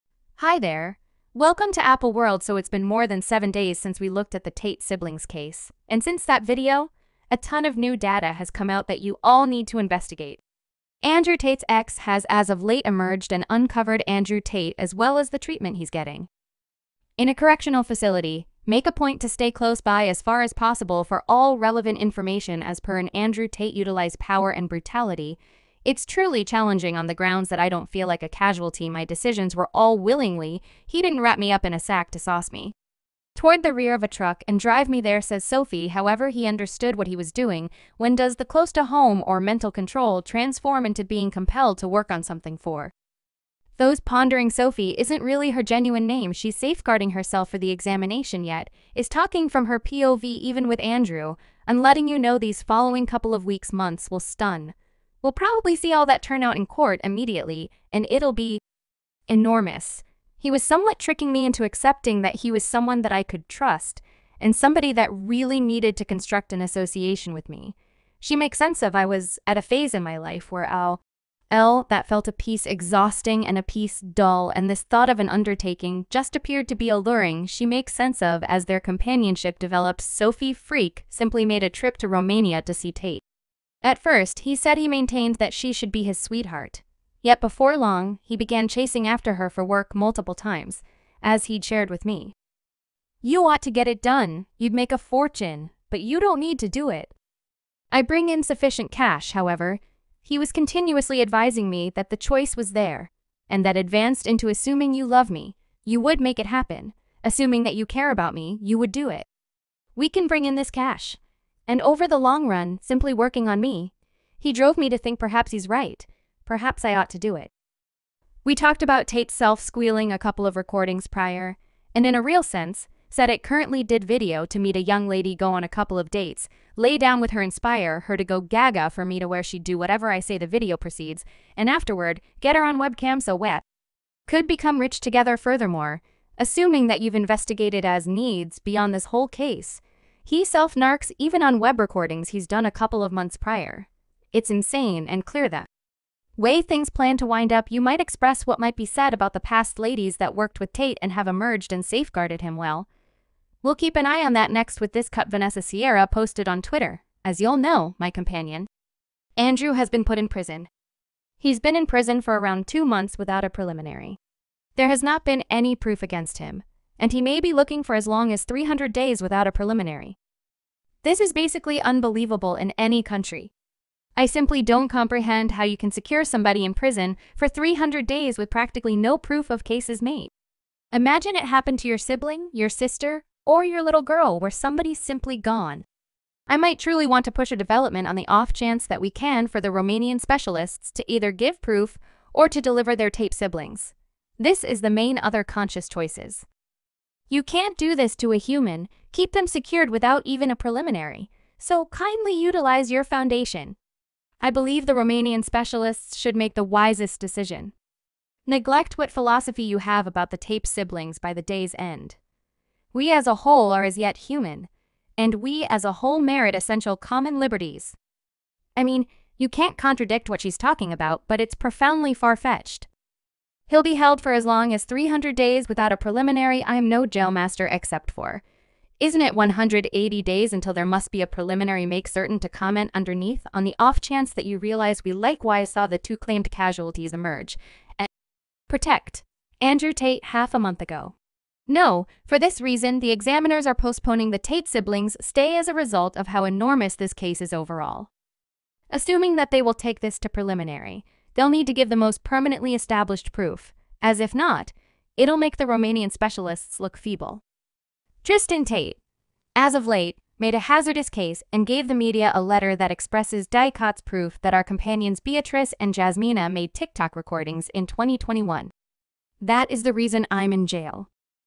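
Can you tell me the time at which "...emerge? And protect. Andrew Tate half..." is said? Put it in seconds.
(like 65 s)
237 s.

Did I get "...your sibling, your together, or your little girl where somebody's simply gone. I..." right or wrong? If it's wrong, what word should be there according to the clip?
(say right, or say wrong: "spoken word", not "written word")
wrong: "sister", not "together".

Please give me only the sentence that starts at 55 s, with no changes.
We'll probably see all that turn out in court immediately, and it'll be enormous.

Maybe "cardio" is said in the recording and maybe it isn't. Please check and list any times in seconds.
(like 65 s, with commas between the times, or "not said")
not said.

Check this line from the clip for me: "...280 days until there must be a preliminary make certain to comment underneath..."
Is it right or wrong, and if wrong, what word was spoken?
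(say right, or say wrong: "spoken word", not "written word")
wrong: "180", not "280".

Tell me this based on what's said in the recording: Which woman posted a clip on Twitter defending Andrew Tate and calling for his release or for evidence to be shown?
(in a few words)
Vanessa Sierra.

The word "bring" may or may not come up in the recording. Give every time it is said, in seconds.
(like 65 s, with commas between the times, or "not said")
98 s, 110 s.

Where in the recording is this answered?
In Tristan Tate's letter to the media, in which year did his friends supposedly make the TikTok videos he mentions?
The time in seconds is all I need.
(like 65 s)
267 s.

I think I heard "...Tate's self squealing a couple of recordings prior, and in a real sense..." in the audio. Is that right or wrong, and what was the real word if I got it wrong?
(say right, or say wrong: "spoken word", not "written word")
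right.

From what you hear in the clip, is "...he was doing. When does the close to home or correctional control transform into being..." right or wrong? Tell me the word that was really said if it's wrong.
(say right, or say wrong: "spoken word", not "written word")
wrong: "mental", not "correctional".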